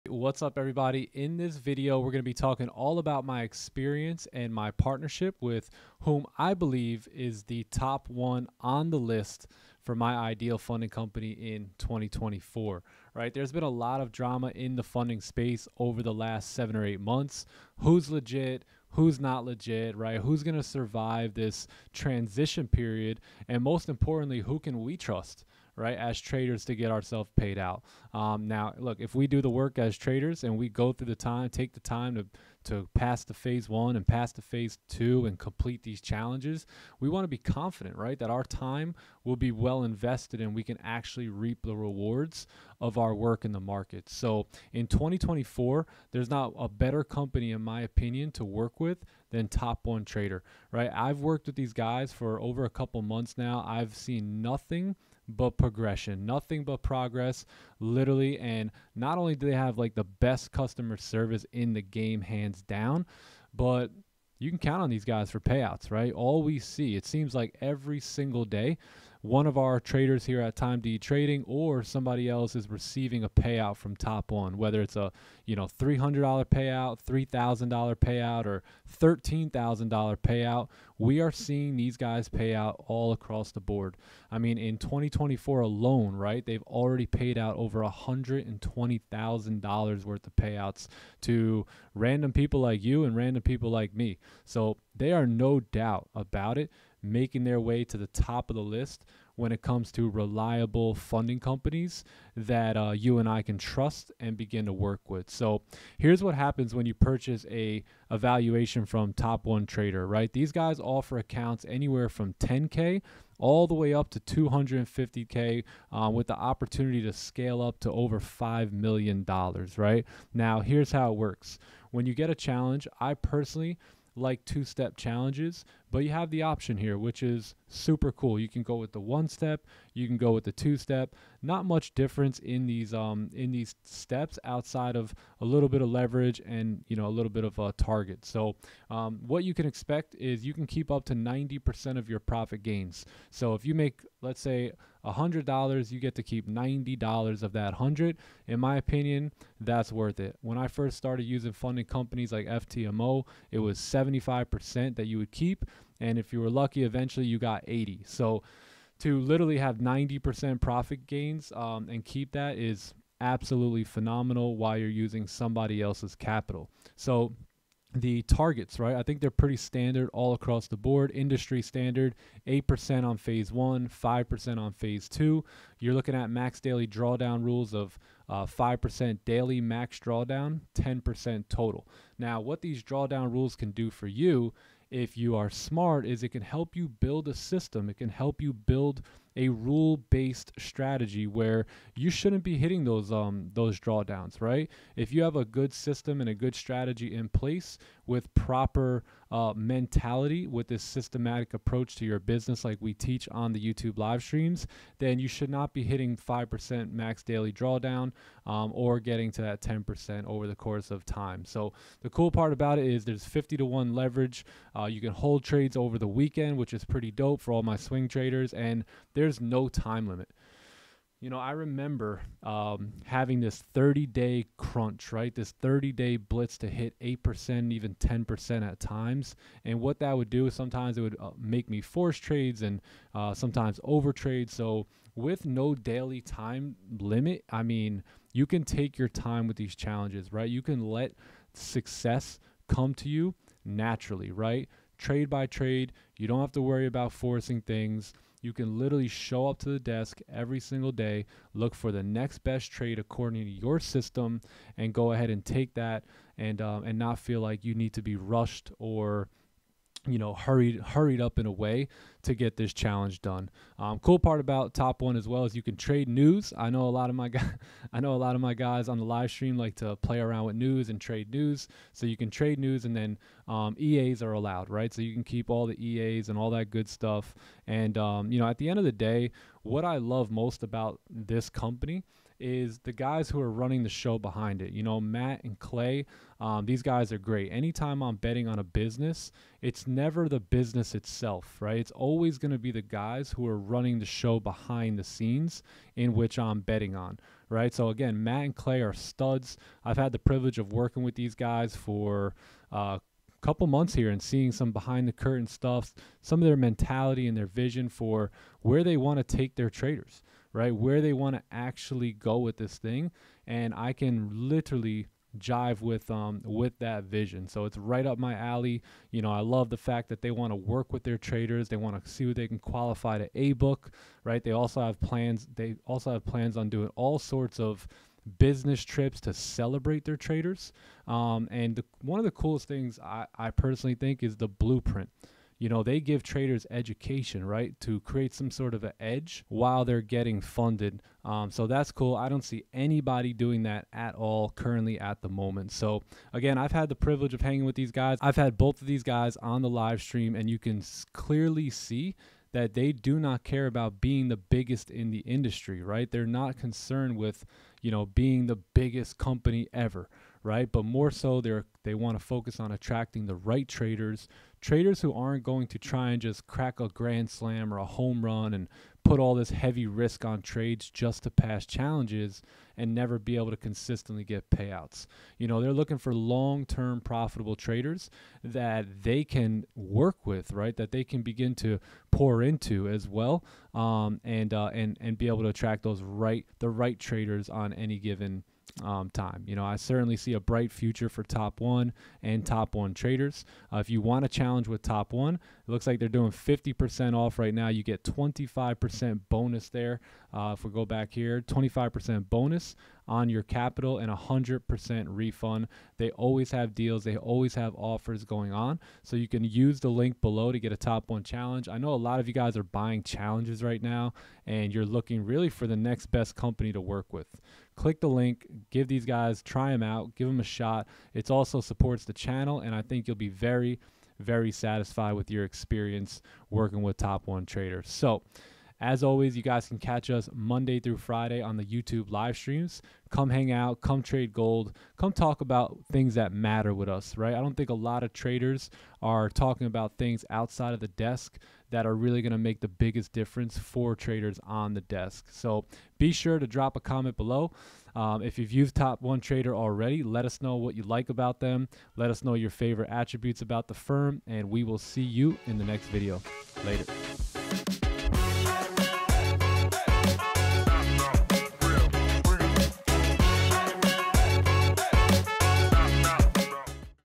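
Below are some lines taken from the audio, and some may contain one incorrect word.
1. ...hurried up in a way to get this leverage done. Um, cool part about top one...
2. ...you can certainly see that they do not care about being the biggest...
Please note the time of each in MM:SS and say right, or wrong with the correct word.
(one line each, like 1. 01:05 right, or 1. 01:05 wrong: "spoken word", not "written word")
1. 04:20 wrong: "challenge", not "leverage"
2. 05:50 wrong: "clearly", not "certainly".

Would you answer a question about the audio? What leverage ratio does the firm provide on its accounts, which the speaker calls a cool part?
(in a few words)
50 to 1.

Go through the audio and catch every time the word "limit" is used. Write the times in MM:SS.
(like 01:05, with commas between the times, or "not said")
03:40, 03:56.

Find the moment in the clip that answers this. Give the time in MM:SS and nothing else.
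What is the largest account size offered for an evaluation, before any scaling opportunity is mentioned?
01:54.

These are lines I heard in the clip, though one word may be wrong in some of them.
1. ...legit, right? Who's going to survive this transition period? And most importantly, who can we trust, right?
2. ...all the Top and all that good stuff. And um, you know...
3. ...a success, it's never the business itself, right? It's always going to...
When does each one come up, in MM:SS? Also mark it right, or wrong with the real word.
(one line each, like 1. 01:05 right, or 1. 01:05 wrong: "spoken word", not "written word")
1. 00:19 right
2. 04:35 wrong: "EAs", not "Top"
3. 04:48 wrong: "business", not "success".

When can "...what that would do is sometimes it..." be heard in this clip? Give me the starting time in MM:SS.
03:49.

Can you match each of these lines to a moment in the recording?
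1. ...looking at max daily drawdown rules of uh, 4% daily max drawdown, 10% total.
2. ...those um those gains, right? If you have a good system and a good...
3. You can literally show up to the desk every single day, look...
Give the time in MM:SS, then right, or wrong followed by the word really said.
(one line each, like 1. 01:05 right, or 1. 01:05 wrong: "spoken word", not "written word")
1. 02:55 wrong: "5", not "4"
2. 03:12 wrong: "drawdowns", not "gains"
3. 04:08 right.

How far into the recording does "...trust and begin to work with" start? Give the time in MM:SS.
01:43.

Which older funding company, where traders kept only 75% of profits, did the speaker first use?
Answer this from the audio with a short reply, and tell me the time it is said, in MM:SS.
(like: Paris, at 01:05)
FTMO, at 02:32.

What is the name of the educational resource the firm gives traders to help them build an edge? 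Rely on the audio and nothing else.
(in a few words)
The blueprint.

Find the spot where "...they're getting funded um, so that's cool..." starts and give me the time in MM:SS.
05:39.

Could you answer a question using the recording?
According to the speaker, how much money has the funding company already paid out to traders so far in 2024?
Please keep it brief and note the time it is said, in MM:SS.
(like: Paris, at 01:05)
Over $120,000, at 01:27.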